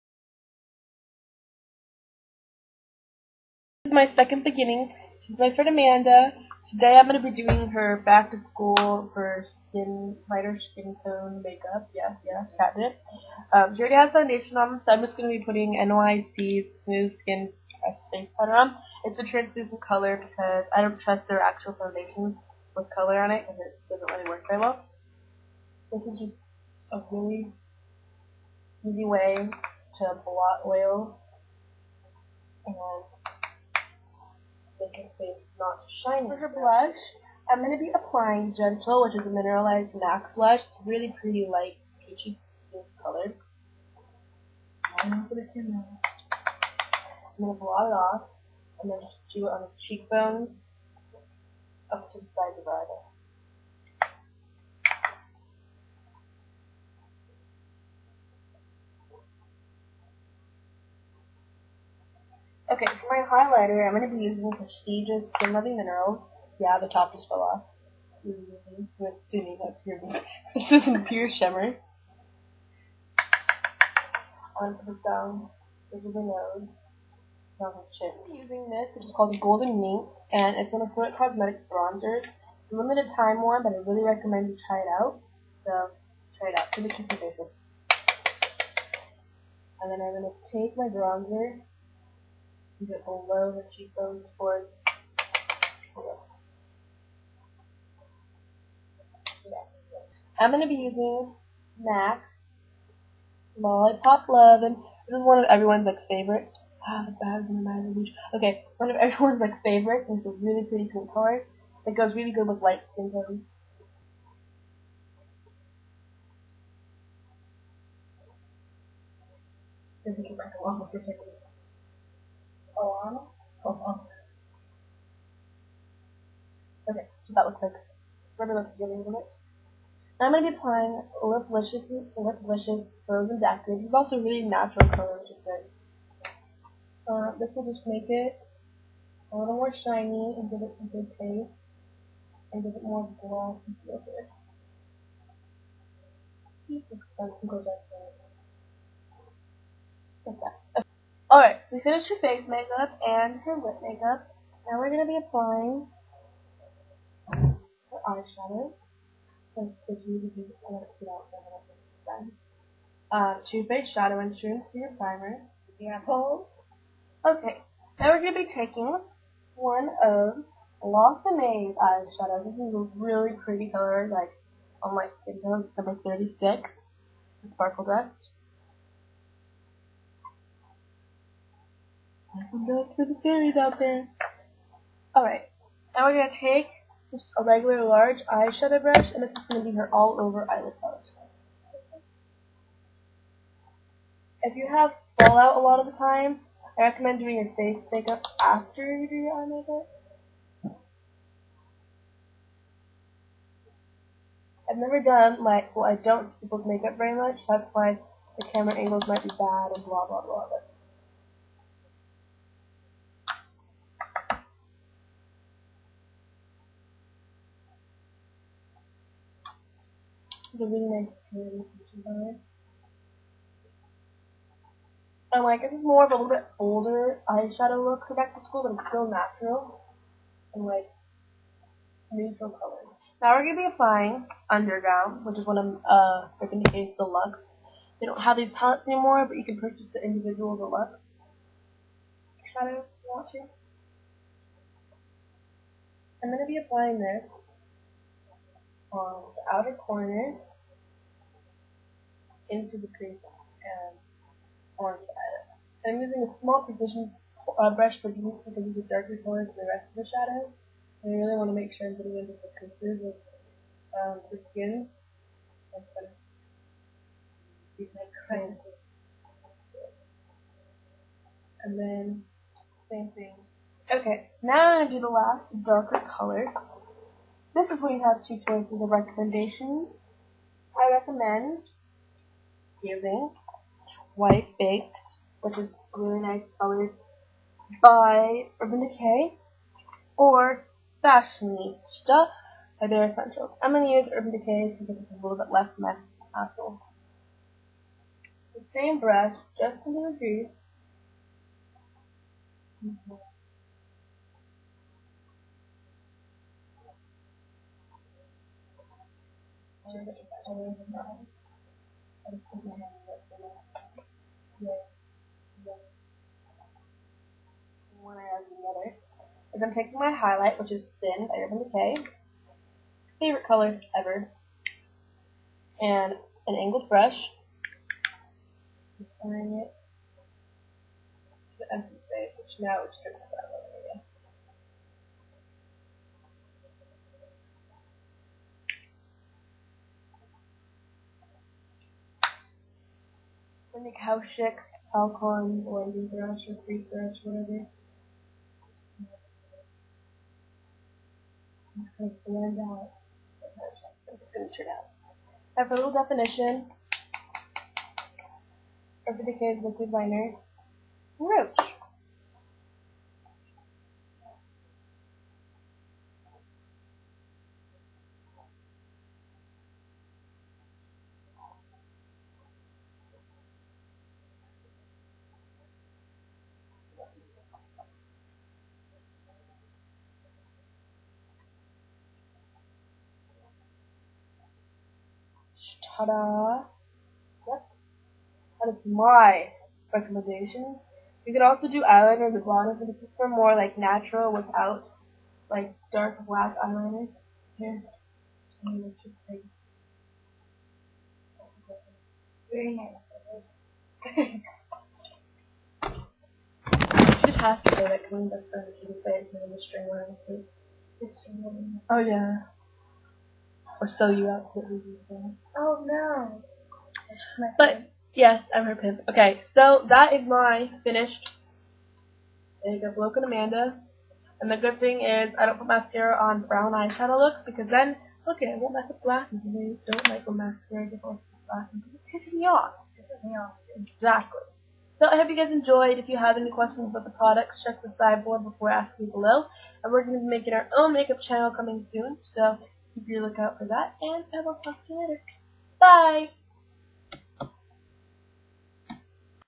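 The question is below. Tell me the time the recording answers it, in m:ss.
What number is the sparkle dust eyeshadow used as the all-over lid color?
2:56.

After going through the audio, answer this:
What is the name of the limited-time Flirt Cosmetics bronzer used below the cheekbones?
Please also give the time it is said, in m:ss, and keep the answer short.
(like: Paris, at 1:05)
Golden Mink, at 1:19.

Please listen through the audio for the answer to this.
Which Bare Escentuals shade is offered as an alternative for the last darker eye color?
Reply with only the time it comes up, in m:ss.
4:51.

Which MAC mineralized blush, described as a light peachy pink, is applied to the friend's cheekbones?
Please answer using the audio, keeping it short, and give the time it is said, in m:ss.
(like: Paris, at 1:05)
Gentle, at 0:38.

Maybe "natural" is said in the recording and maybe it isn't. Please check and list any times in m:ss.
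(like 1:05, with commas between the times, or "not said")
2:14, 3:49, 6:33.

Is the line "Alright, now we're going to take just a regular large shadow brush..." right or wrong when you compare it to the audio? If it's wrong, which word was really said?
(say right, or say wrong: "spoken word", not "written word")
wrong: "eyeshadow", not "shadow".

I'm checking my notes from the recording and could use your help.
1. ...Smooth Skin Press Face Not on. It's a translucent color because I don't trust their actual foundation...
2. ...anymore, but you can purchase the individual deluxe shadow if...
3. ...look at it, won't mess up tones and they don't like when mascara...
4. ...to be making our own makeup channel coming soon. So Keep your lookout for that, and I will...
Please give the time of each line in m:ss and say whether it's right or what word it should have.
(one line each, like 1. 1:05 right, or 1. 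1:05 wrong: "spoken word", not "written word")
1. 0:16 wrong: "Powder", not "Not"
2. 3:58 right
3. 7:08 wrong: "glasses", not "tones"
4. 7:20 right.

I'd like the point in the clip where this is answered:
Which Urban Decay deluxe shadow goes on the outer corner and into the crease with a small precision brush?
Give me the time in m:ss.
3:54.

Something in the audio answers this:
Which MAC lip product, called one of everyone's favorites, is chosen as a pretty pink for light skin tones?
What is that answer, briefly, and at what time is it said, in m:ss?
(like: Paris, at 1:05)
Lollipop Love, at 1:43.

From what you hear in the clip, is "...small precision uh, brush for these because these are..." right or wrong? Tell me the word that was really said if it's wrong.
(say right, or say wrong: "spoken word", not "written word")
right.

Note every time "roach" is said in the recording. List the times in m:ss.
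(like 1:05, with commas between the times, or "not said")
6:01.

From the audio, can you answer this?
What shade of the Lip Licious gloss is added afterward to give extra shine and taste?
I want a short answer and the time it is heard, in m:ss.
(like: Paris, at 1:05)
Frozen Daiquiri, at 2:13.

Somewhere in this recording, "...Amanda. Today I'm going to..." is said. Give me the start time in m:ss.
0:05.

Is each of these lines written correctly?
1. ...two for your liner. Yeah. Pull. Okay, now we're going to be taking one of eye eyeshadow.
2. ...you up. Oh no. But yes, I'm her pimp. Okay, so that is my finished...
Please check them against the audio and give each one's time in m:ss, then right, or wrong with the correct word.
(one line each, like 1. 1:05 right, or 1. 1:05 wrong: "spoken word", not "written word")
1. 2:44 wrong: "primer", not "liner"
2. 6:54 right.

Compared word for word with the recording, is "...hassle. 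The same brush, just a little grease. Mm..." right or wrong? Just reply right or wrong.
right.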